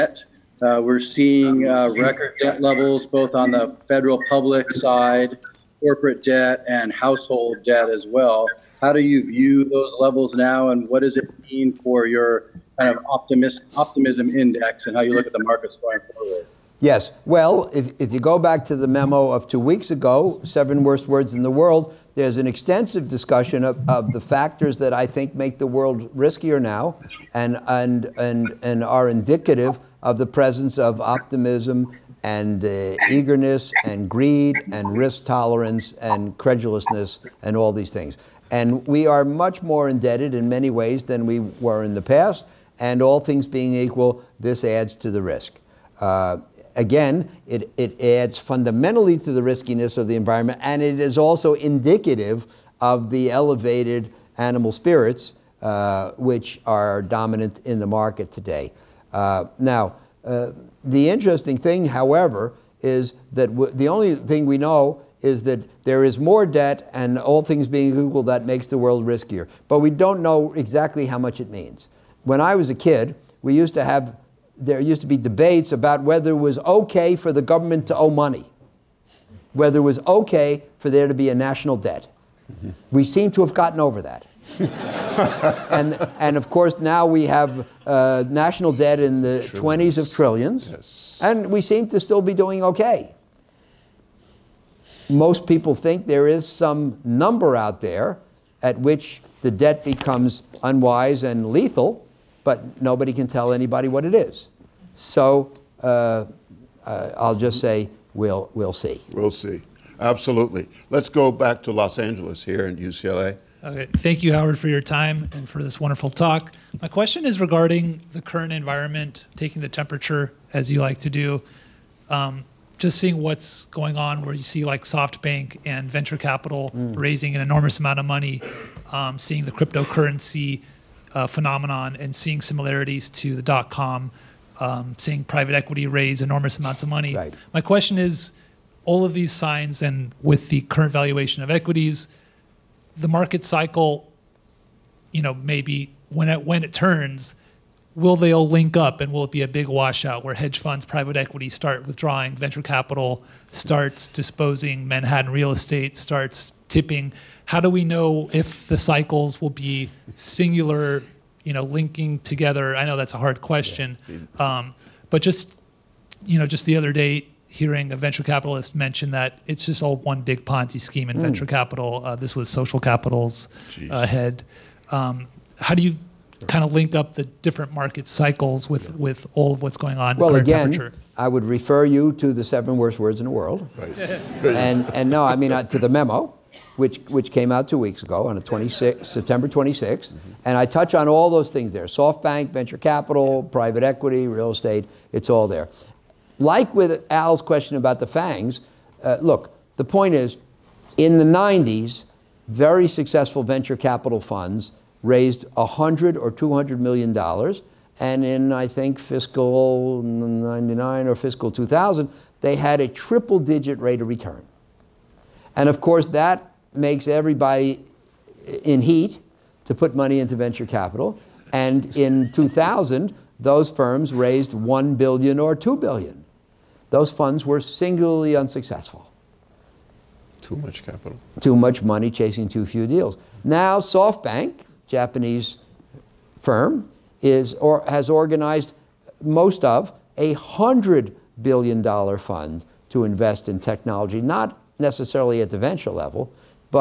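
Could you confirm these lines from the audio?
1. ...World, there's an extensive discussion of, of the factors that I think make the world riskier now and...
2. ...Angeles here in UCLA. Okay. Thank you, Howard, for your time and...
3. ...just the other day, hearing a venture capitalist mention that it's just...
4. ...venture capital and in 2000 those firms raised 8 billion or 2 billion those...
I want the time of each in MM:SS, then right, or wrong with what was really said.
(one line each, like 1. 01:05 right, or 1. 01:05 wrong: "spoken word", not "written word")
1. 00:21 right
2. 01:51 right
3. 02:46 right
4. 03:40 wrong: "1", not "8".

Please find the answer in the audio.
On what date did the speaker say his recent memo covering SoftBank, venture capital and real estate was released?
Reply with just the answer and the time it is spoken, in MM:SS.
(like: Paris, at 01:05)
September 26th, at 03:09.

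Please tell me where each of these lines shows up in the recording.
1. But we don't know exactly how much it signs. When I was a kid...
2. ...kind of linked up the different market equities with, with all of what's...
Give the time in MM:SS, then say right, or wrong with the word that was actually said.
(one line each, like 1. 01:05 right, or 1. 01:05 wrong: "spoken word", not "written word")
1. 01:09 wrong: "means", not "signs"
2. 02:56 wrong: "cycles", not "equities".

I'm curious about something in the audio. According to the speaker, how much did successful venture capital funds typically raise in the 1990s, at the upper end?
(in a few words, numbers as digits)
200 million dollars.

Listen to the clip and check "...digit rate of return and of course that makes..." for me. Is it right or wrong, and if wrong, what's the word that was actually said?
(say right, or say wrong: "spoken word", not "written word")
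right.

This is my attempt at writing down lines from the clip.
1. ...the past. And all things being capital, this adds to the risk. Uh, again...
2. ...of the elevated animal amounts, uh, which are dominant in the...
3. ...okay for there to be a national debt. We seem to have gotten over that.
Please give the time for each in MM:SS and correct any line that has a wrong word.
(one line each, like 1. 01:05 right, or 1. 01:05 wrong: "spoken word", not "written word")
1. 00:41 wrong: "equal", not "capital"
2. 00:52 wrong: "spirits", not "amounts"
3. 01:20 right.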